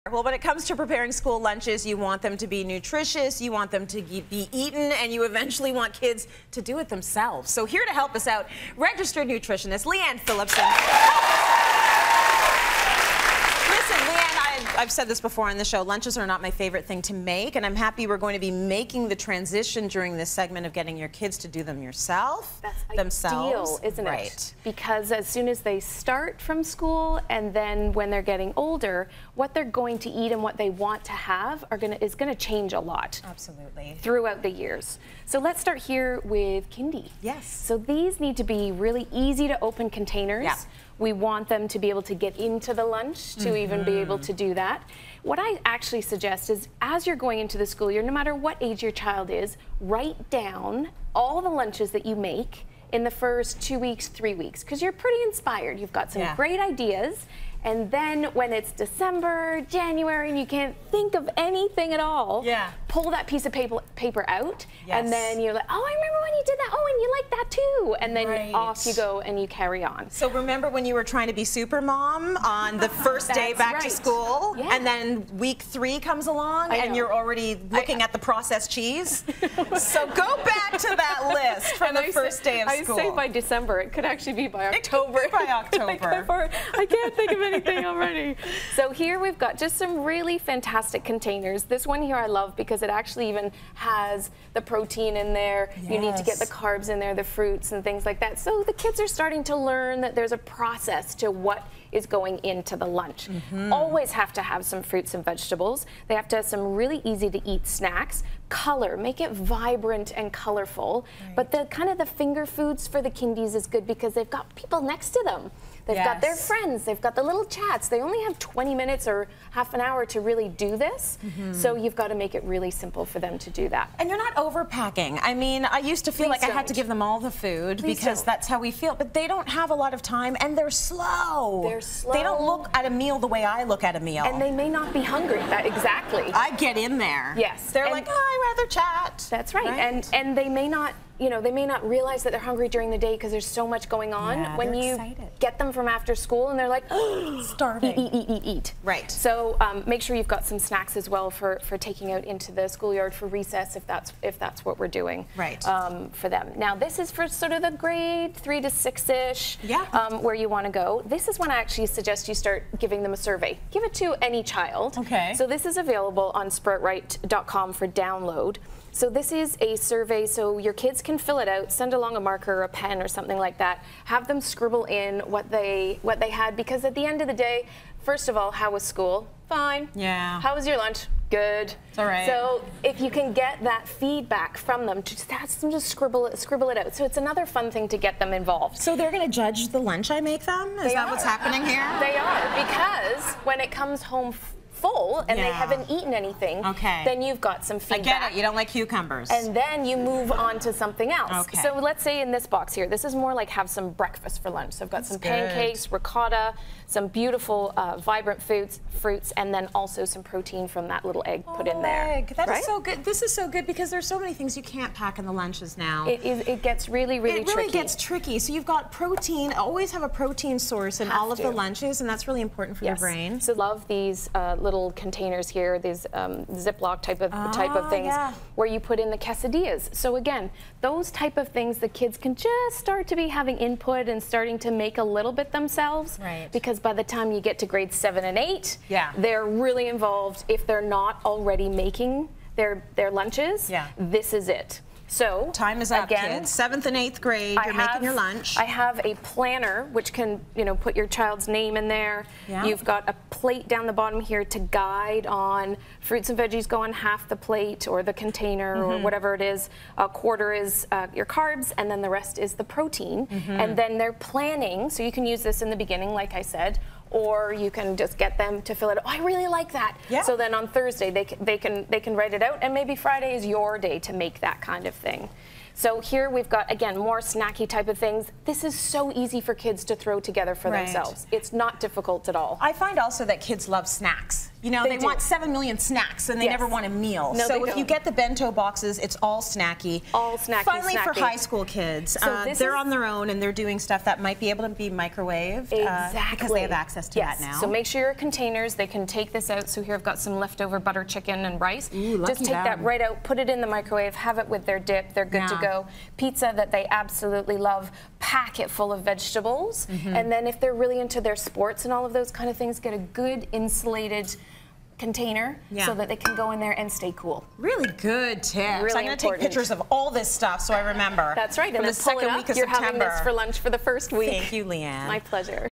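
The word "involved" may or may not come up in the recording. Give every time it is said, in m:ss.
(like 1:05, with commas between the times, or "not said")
3:08, 3:59.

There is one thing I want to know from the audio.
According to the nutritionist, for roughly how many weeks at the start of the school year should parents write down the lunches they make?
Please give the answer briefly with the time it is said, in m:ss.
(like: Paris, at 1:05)
3 weeks, at 0:54.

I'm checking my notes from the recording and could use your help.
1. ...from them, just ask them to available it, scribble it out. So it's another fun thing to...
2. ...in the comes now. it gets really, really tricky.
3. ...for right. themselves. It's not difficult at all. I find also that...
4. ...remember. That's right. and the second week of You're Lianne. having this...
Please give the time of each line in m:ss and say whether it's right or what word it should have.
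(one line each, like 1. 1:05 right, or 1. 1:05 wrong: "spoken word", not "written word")
1. 3:04 wrong: "scribble", not "available"
2. 3:35 wrong: "lunches", not "comes"
3. 4:40 right
4. 5:20 wrong: "September", not "Lianne".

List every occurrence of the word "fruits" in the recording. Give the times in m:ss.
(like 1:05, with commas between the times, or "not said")
1:37, 1:44, 3:28, 4:15.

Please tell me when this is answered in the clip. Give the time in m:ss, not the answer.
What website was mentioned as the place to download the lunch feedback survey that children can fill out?
2:46.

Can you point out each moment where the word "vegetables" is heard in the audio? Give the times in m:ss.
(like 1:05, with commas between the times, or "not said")
1:45, 5:09.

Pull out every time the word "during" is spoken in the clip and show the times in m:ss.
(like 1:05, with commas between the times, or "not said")
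0:19, 2:22.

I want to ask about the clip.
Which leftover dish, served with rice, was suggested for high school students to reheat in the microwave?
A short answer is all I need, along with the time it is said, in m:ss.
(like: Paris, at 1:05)
Butter chicken, at 5:00.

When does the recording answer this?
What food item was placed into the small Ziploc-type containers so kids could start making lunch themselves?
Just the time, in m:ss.
3:49.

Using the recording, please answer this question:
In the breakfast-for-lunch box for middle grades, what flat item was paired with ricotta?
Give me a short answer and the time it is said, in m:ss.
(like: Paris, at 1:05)
Pancakes, at 3:25.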